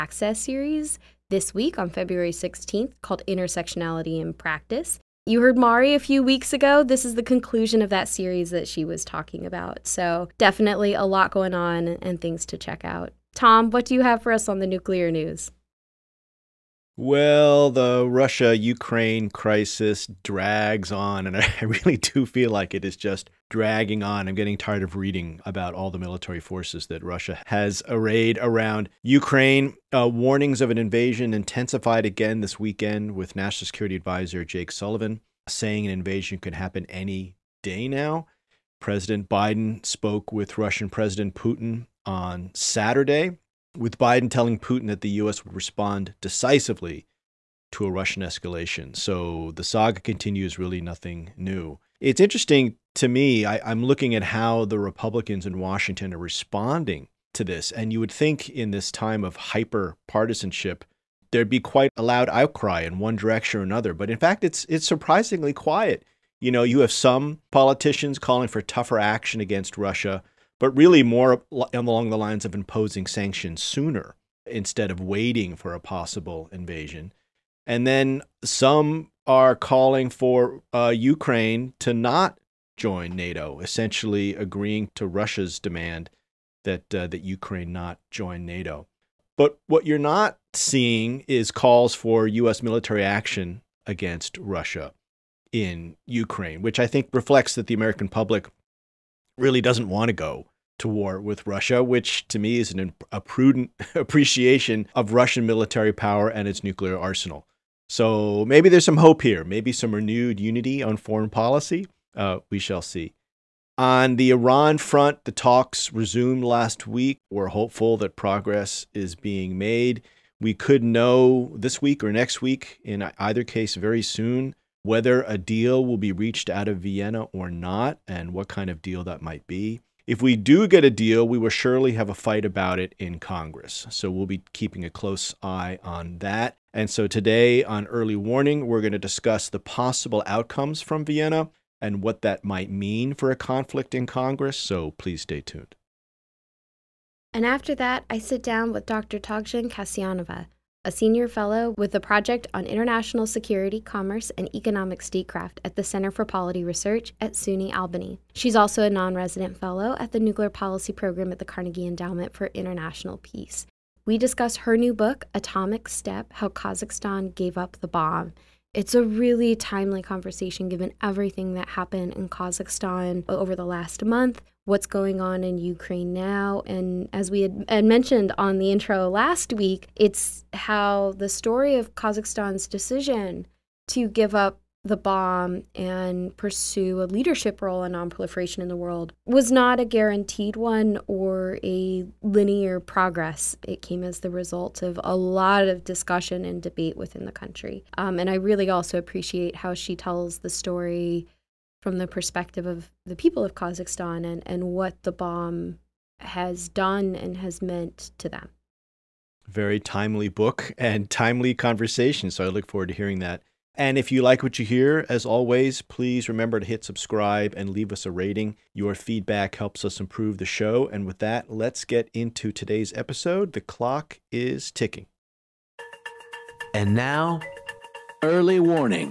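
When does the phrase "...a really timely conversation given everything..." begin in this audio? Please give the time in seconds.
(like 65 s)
168 s.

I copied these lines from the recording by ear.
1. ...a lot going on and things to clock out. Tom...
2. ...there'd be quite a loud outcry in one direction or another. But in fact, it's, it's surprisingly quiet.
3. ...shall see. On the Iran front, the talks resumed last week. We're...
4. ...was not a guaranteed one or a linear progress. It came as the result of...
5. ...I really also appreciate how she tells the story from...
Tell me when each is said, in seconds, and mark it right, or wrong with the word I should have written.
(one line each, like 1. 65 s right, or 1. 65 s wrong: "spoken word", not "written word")
1. 10 s wrong: "check", not "clock"
2. 61 s right
3. 112 s right
4. 189 s right
5. 198 s right.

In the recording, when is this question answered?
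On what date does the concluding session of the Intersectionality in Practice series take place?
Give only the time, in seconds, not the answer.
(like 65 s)
1 s.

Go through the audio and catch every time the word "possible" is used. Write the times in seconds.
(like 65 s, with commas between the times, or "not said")
75 s, 139 s.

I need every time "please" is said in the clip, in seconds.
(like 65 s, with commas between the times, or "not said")
144 s, 215 s.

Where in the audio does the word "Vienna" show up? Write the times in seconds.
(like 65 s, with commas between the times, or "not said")
126 s, 141 s.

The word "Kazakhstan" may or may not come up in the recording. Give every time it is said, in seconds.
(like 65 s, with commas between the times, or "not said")
166 s, 172 s, 181 s, 203 s.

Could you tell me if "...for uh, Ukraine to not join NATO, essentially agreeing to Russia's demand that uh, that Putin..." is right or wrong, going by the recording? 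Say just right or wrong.
wrong.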